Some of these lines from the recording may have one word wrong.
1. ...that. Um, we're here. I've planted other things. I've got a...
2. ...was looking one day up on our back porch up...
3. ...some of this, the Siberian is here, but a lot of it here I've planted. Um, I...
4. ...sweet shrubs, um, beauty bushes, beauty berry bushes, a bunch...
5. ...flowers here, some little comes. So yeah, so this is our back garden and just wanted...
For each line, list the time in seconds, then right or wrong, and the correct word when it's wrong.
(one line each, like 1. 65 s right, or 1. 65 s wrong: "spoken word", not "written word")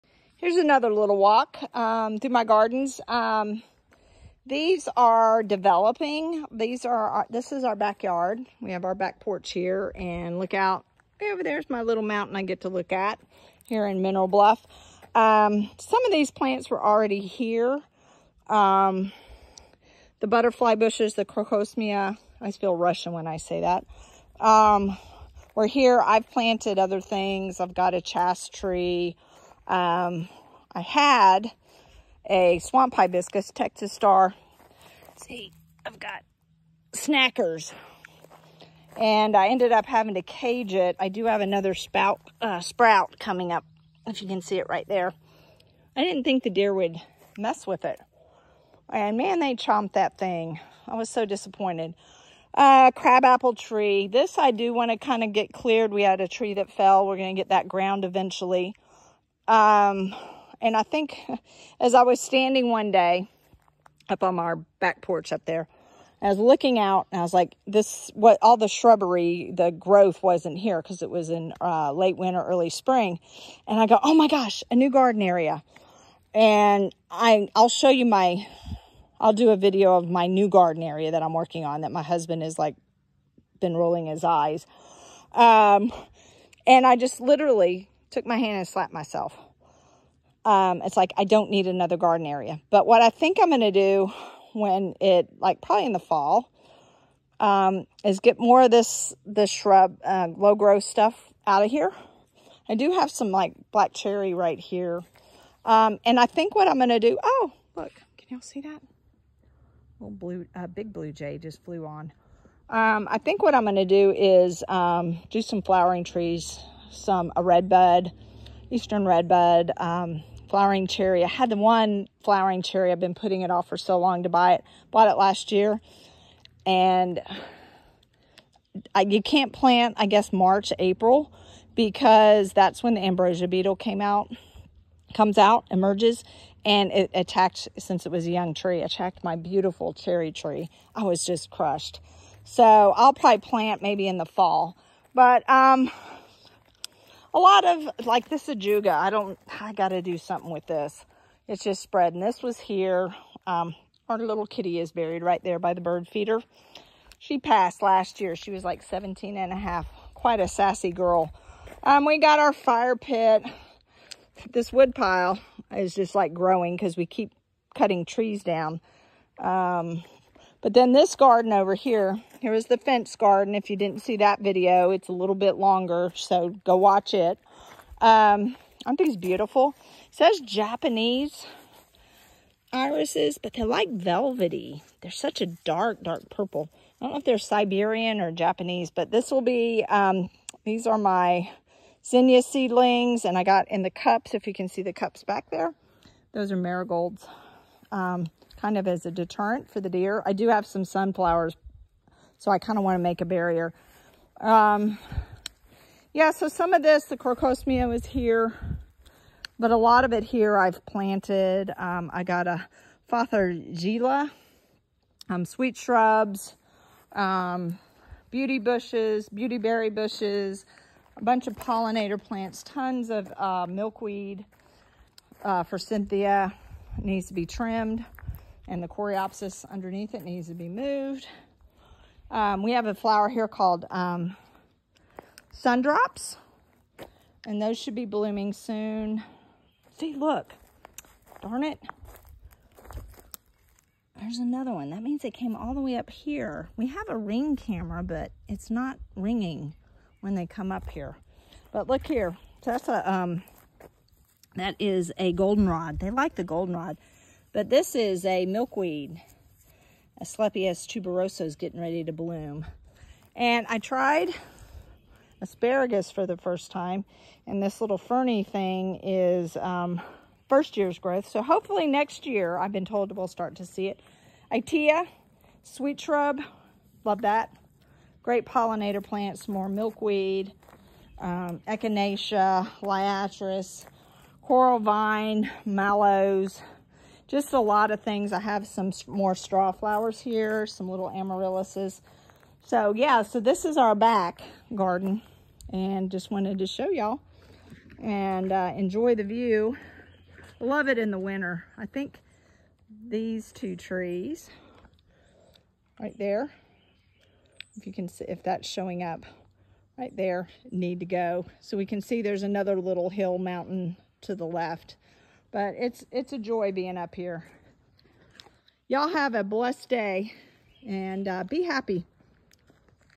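1. 23 s right
2. 62 s wrong: "standing", not "looking"
3. 206 s wrong: "Crocosmia", not "Siberian"
4. 215 s right
5. 289 s wrong: "amaryllises", not "comes".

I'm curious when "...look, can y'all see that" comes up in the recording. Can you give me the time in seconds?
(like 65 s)
107 s.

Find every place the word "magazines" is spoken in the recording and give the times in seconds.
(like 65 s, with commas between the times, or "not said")
not said.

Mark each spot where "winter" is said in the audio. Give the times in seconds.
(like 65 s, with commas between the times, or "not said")
72 s, 301 s.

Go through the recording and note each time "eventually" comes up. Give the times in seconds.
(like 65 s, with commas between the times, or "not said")
58 s.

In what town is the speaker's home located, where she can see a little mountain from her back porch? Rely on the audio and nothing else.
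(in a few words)
Mineral Bluff.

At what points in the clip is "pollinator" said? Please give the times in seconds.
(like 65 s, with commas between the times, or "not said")
221 s, 278 s.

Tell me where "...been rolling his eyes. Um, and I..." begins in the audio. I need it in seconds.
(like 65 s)
83 s.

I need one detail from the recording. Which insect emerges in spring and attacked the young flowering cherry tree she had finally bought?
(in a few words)
ambrosia beetle.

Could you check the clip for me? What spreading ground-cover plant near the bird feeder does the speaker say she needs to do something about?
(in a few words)
ajuga.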